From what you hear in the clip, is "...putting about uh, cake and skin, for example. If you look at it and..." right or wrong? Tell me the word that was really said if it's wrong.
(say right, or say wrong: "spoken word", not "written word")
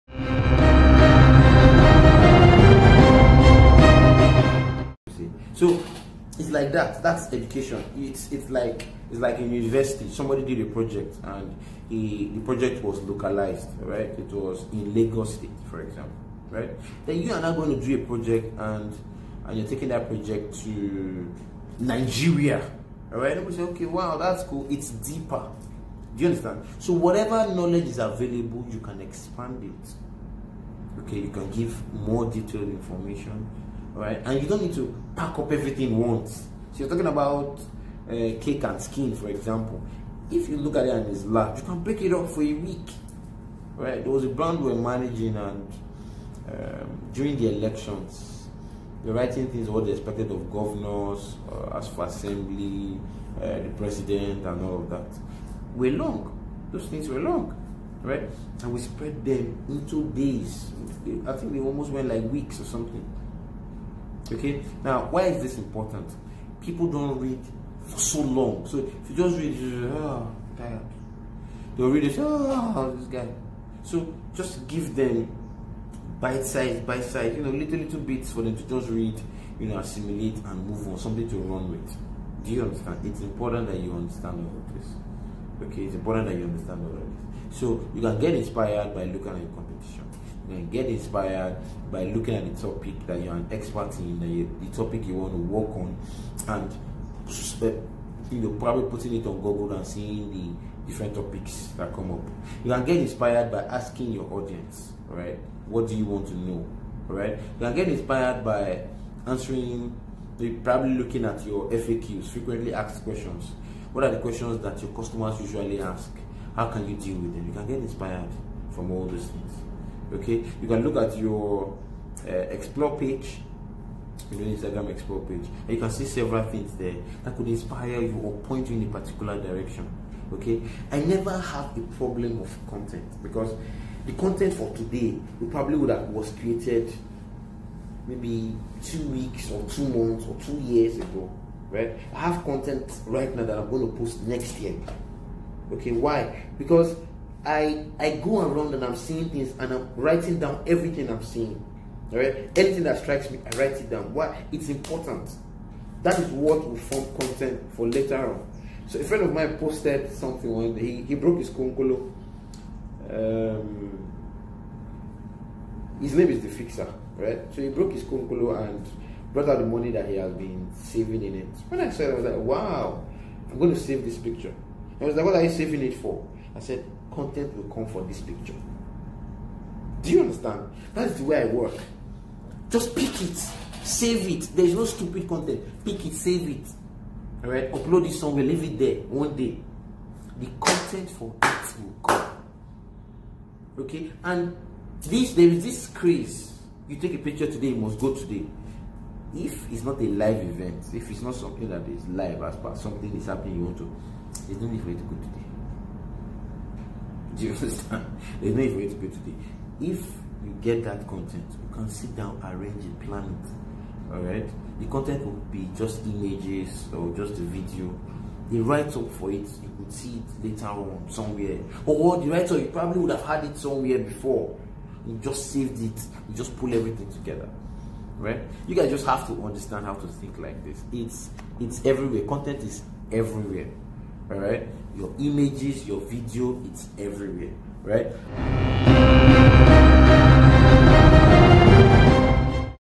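wrong: "talking", not "putting".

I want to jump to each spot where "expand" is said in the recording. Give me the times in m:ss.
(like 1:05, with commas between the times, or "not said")
0:28.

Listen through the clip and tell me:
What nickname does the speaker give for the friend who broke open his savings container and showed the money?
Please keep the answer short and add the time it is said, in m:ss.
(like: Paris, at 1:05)
The Fixer, at 2:46.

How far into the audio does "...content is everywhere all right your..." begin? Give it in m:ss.
3:52.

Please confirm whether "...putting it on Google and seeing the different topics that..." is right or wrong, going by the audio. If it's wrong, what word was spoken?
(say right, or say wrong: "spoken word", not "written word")
right.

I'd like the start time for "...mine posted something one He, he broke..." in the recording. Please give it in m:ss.
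2:39.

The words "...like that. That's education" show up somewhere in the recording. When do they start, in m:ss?
0:06.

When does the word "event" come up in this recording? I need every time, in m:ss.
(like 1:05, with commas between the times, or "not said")
3:20.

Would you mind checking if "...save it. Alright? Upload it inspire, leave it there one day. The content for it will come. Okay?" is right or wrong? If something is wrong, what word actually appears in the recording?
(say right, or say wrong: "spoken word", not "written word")
wrong: "somewhere", not "inspire".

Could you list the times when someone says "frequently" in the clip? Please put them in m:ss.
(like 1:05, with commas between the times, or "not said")
1:52.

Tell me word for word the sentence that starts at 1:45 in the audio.
What do you want to know, right?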